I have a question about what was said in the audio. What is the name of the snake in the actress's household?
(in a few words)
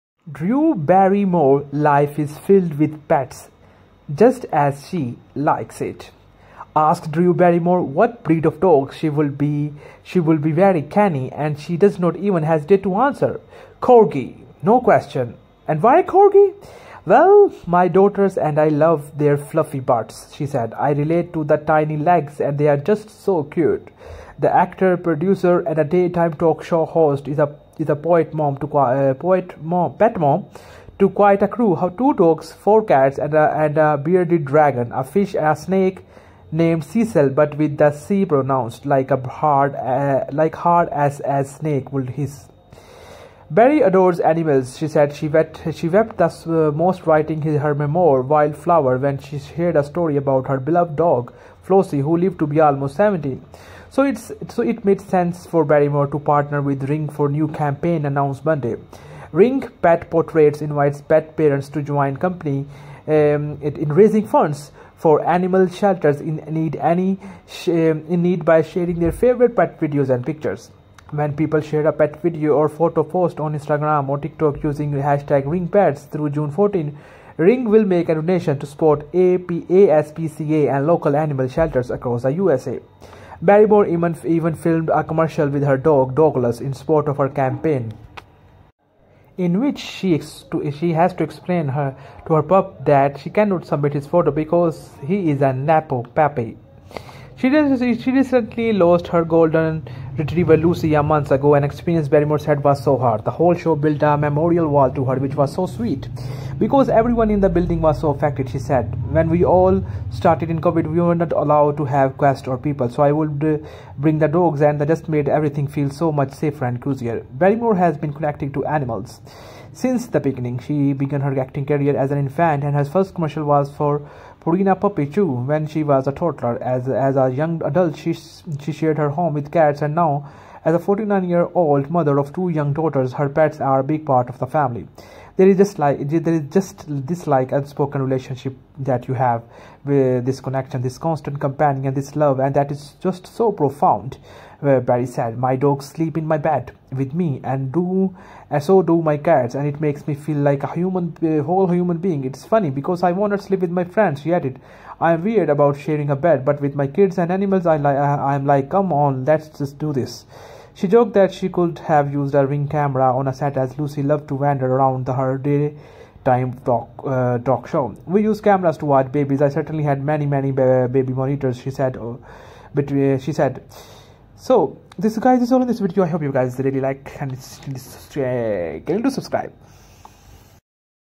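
Cecil.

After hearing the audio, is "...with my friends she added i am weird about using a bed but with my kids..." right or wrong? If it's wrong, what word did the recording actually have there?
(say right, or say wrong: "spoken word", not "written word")
wrong: "sharing", not "using".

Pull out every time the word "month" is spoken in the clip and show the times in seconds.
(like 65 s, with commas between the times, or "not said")
101 s.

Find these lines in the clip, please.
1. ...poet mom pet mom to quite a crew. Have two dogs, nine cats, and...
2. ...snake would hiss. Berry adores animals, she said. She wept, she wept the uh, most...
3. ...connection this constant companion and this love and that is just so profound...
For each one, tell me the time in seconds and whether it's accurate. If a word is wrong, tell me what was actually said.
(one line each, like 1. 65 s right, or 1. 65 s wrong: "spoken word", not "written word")
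1. 29 s wrong: "four", not "nine"
2. 41 s right
3. 140 s right.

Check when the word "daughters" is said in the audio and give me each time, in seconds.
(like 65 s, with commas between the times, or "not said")
17 s, 132 s.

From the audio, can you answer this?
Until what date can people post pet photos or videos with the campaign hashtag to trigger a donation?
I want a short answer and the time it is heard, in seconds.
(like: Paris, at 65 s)
June 14, at 76 s.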